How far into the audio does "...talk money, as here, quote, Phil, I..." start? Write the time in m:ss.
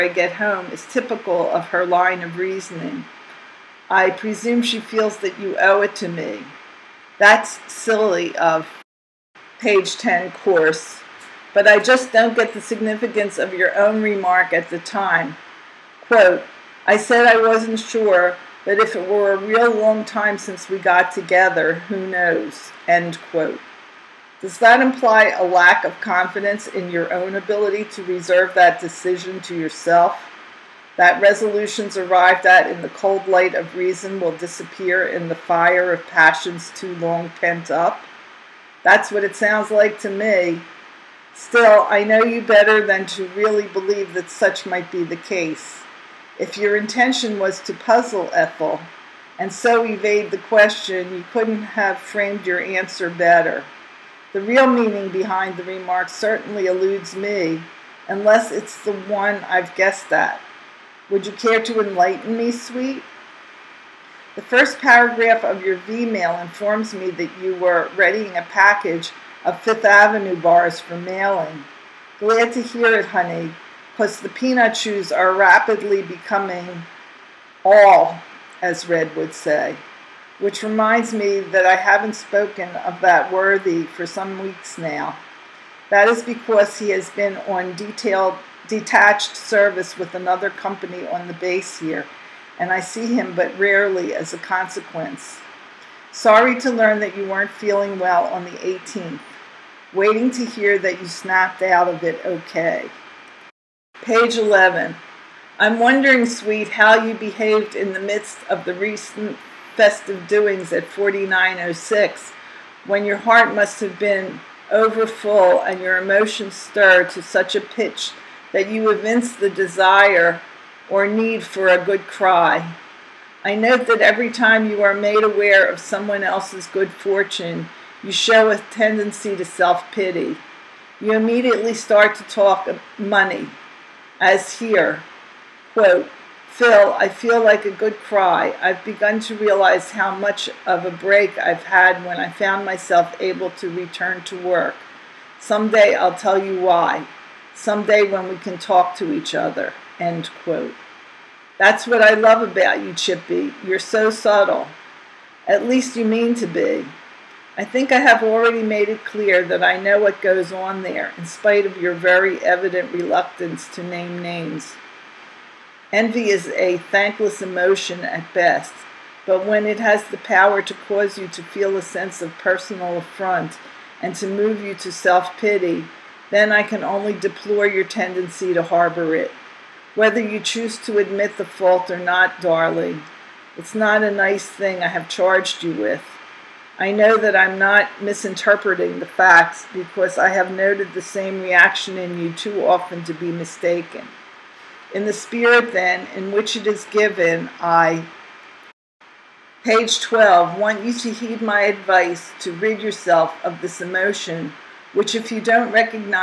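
2:12.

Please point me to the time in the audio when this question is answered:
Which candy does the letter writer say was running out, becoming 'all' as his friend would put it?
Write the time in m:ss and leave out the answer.
1:14.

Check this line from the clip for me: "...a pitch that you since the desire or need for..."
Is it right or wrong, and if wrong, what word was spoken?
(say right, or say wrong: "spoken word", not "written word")
wrong: "evince", not "since".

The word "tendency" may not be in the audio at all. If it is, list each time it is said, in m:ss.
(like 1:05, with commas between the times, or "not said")
2:08, 2:57.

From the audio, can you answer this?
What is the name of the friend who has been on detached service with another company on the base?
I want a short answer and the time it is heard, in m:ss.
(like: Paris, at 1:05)
Red, at 1:18.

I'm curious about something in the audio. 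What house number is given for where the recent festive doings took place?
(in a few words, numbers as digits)
4906.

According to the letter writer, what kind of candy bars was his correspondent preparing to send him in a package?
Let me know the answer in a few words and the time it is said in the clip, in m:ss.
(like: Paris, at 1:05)
Fifth Avenue bars, at 1:09.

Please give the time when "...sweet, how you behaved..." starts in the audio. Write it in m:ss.
1:46.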